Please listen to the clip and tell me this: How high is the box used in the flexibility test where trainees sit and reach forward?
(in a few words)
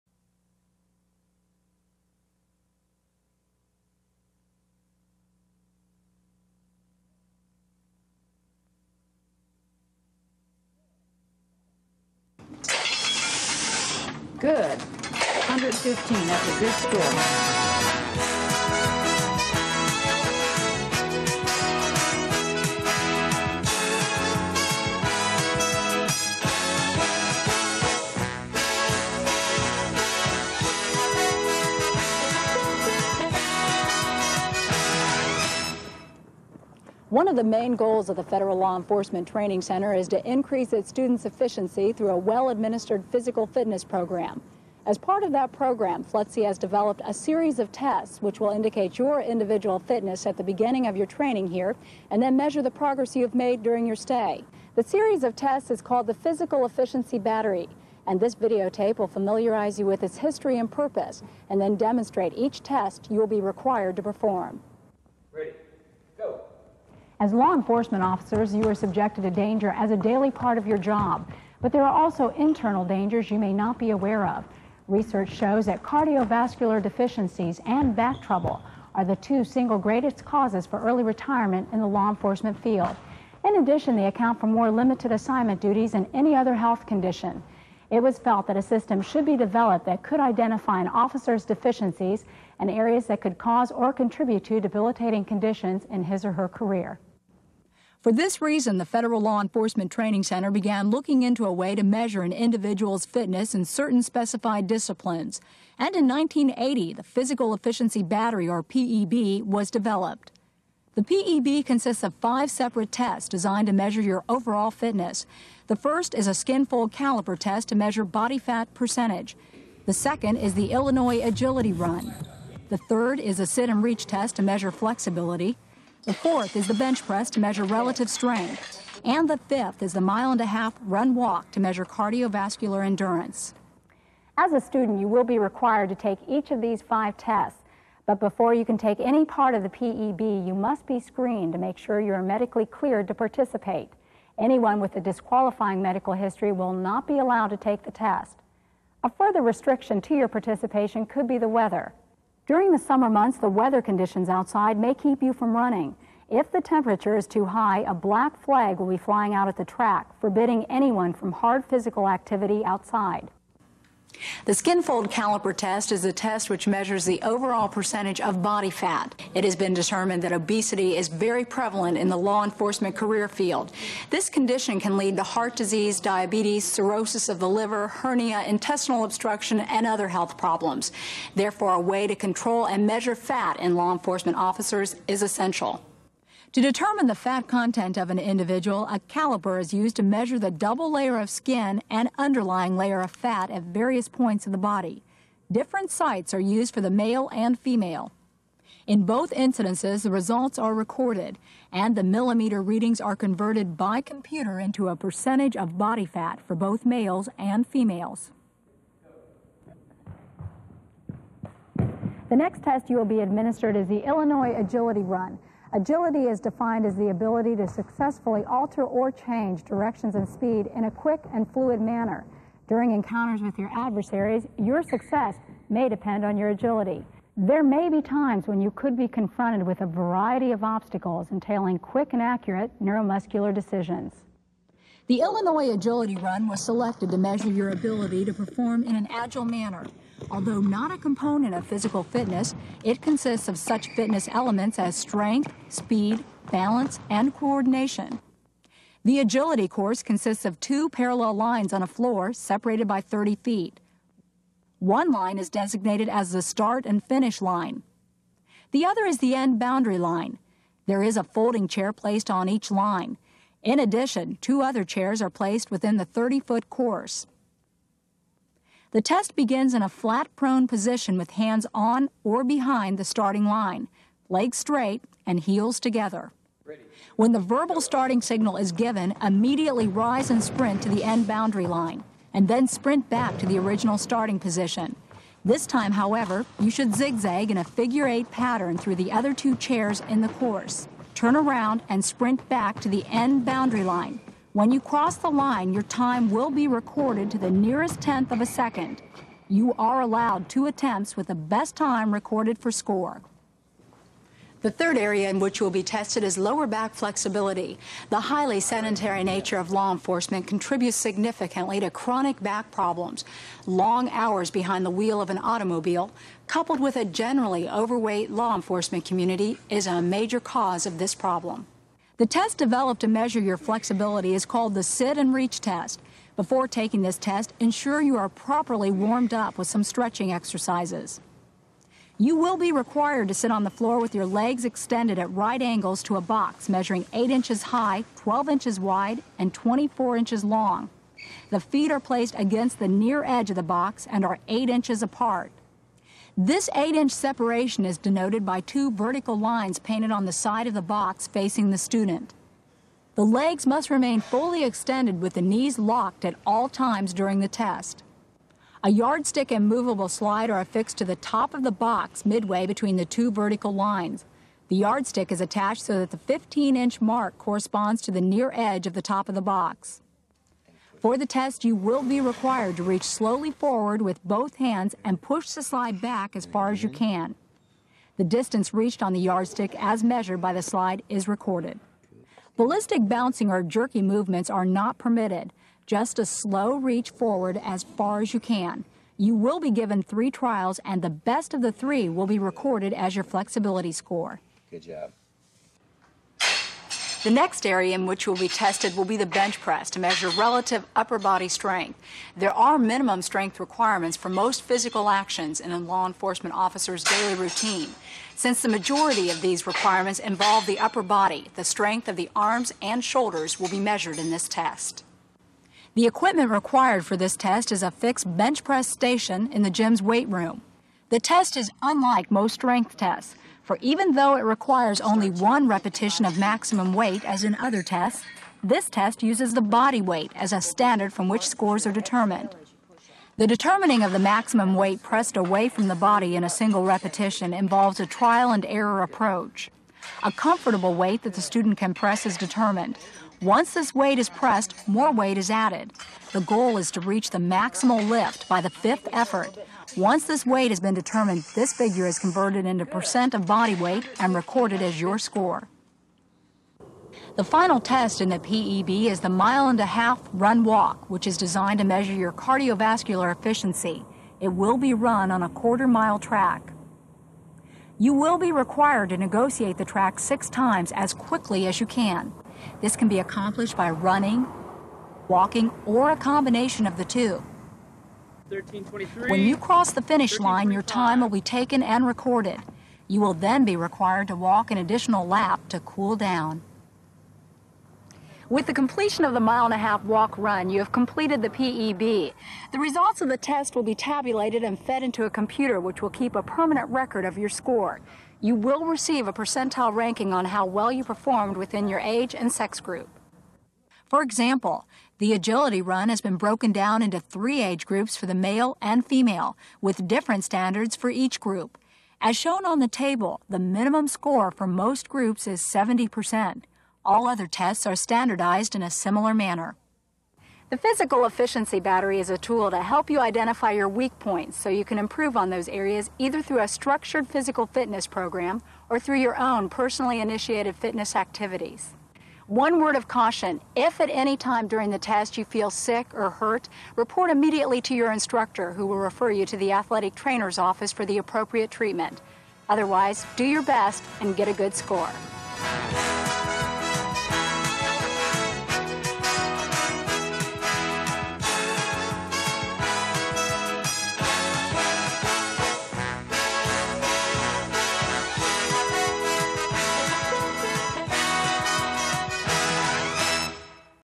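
8 inches.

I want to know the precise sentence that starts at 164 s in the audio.
The skinfold caliper test is a test which measures the overall percentage of body fat.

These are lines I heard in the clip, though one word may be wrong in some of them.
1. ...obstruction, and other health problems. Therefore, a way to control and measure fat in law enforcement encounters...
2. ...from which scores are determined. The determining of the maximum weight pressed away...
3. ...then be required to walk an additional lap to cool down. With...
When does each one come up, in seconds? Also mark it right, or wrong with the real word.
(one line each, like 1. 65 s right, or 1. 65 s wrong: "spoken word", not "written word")
1. 179 s wrong: "officers", not "encounters"
2. 431 s right
3. 483 s right.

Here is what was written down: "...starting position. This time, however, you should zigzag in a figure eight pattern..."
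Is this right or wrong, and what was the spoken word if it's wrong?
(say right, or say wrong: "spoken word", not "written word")
right.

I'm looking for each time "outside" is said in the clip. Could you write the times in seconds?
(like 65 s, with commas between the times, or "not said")
154 s, 162 s.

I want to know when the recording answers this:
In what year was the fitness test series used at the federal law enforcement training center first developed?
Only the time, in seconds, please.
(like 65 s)
106 s.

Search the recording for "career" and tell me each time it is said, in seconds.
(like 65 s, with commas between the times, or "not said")
96 s, 172 s.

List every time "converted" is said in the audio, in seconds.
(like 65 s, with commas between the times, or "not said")
203 s, 452 s.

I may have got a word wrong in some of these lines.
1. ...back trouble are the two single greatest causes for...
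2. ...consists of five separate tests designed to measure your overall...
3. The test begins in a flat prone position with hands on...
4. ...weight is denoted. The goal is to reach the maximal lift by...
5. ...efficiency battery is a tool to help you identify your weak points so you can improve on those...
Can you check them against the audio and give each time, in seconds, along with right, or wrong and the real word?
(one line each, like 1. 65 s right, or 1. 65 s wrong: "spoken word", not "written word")
1. 77 s right
2. 111 s right
3. 268 s right
4. 445 s wrong: "added", not "denoted"
5. 521 s right.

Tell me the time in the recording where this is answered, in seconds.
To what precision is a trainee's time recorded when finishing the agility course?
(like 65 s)
297 s.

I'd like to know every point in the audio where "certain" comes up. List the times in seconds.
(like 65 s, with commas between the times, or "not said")
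103 s.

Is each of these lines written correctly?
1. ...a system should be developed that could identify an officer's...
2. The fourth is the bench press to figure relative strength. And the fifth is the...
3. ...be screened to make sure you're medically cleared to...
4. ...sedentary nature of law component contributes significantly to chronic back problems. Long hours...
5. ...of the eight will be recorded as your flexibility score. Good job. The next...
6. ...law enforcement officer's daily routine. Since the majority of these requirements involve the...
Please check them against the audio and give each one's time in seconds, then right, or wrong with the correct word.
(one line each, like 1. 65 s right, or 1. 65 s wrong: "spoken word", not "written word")
1. 88 s right
2. 126 s wrong: "measure", not "figure"
3. 140 s right
4. 308 s wrong: "enforcement", not "component"
5. 391 s wrong: "three", not "eight"
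6. 405 s right.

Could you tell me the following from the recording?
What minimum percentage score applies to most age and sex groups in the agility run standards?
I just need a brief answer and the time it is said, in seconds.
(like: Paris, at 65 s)
70 percent, at 515 s.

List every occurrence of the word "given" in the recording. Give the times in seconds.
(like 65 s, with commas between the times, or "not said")
278 s, 389 s.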